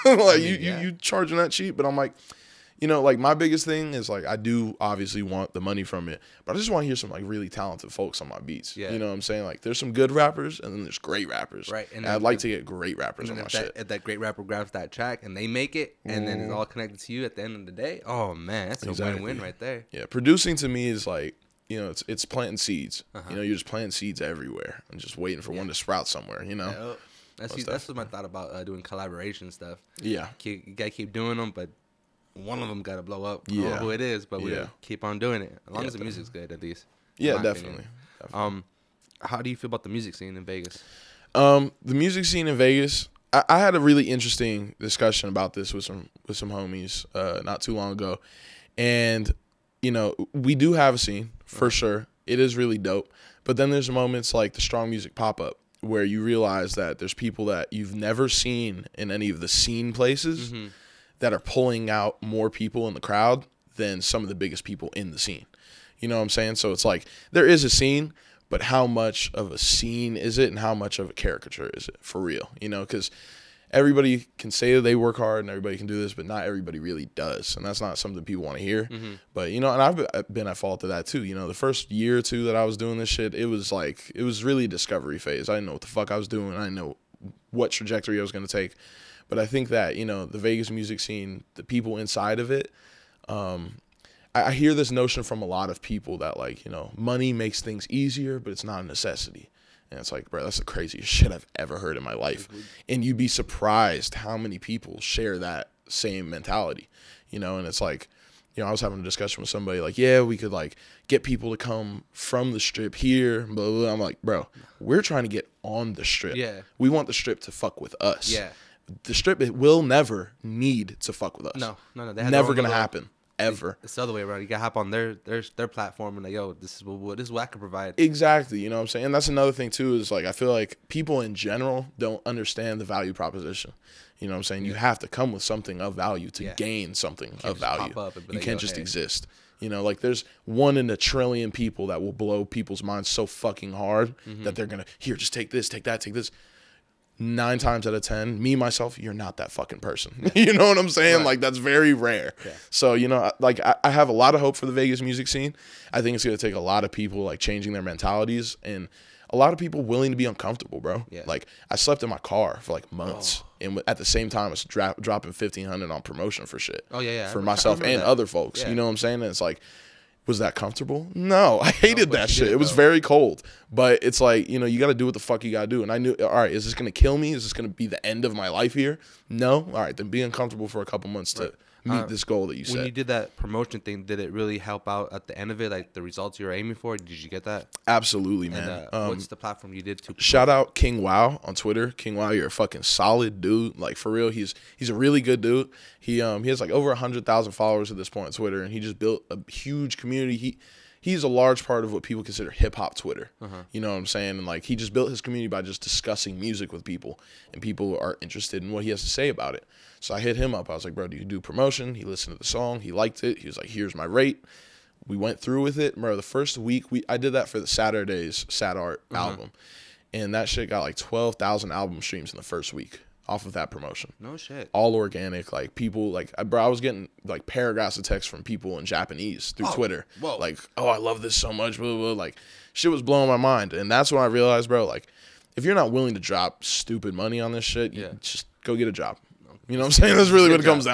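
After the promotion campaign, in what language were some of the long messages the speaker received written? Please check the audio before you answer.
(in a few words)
Japanese.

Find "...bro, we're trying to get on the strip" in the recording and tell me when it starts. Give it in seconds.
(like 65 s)
114 s.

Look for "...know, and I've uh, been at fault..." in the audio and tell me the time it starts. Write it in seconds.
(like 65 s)
79 s.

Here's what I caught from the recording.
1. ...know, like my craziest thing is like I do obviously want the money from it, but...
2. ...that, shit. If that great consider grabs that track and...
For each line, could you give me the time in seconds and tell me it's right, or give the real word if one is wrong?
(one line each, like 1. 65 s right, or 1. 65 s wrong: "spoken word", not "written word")
1. 2 s wrong: "biggest", not "craziest"
2. 13 s wrong: "rapper", not "consider".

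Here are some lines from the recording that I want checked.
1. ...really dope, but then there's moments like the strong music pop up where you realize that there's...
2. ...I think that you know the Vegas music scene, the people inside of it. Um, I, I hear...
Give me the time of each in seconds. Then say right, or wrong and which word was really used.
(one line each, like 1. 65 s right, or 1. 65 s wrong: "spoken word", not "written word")
1. 52 s right
2. 89 s right.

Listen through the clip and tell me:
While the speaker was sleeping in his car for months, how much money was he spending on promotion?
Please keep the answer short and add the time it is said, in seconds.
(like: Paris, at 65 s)
1500, at 165 s.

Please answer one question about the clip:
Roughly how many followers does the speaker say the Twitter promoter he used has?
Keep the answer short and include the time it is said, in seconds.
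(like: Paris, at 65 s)
over 100,000, at 196 s.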